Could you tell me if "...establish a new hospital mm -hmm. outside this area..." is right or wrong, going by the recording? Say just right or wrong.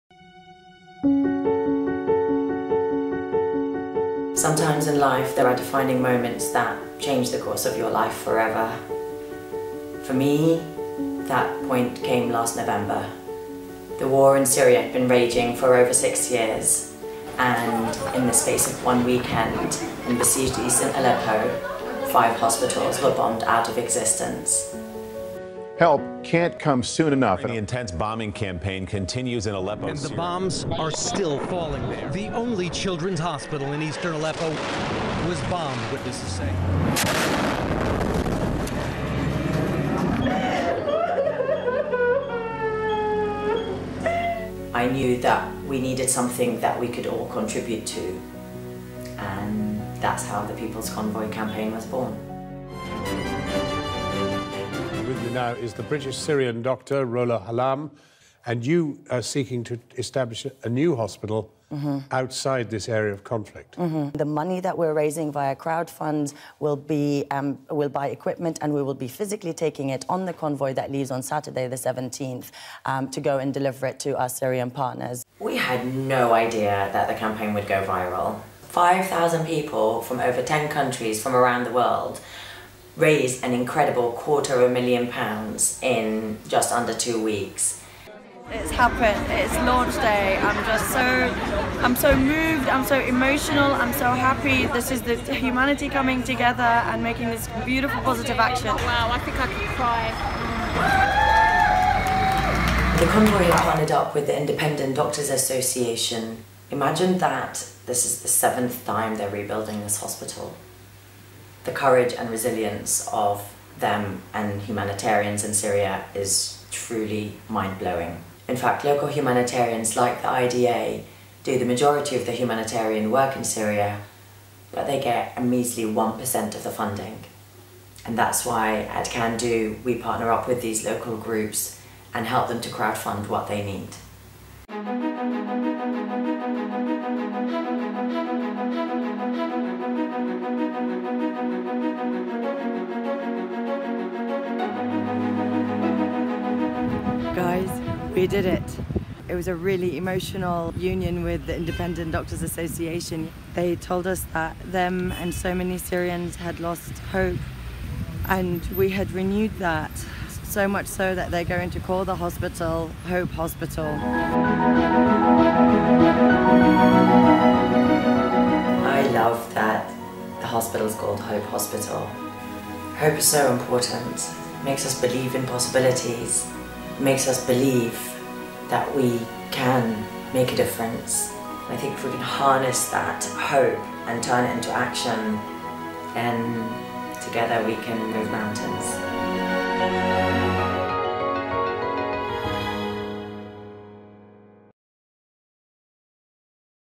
right.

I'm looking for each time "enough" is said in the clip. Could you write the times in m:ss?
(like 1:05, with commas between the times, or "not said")
0:27.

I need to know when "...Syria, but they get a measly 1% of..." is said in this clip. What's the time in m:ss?
2:03.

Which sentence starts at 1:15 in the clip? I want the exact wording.
We had no idea that the campaign would go viral.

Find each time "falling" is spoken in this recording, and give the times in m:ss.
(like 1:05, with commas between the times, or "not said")
0:31.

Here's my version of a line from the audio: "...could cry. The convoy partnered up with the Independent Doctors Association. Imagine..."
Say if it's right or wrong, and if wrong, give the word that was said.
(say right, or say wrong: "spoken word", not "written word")
right.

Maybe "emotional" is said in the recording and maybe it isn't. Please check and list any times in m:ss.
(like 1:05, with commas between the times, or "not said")
1:32, 2:29.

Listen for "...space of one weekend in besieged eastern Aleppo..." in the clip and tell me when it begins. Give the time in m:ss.
0:18.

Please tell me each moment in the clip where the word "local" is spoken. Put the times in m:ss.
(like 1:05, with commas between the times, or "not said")
1:58, 2:10.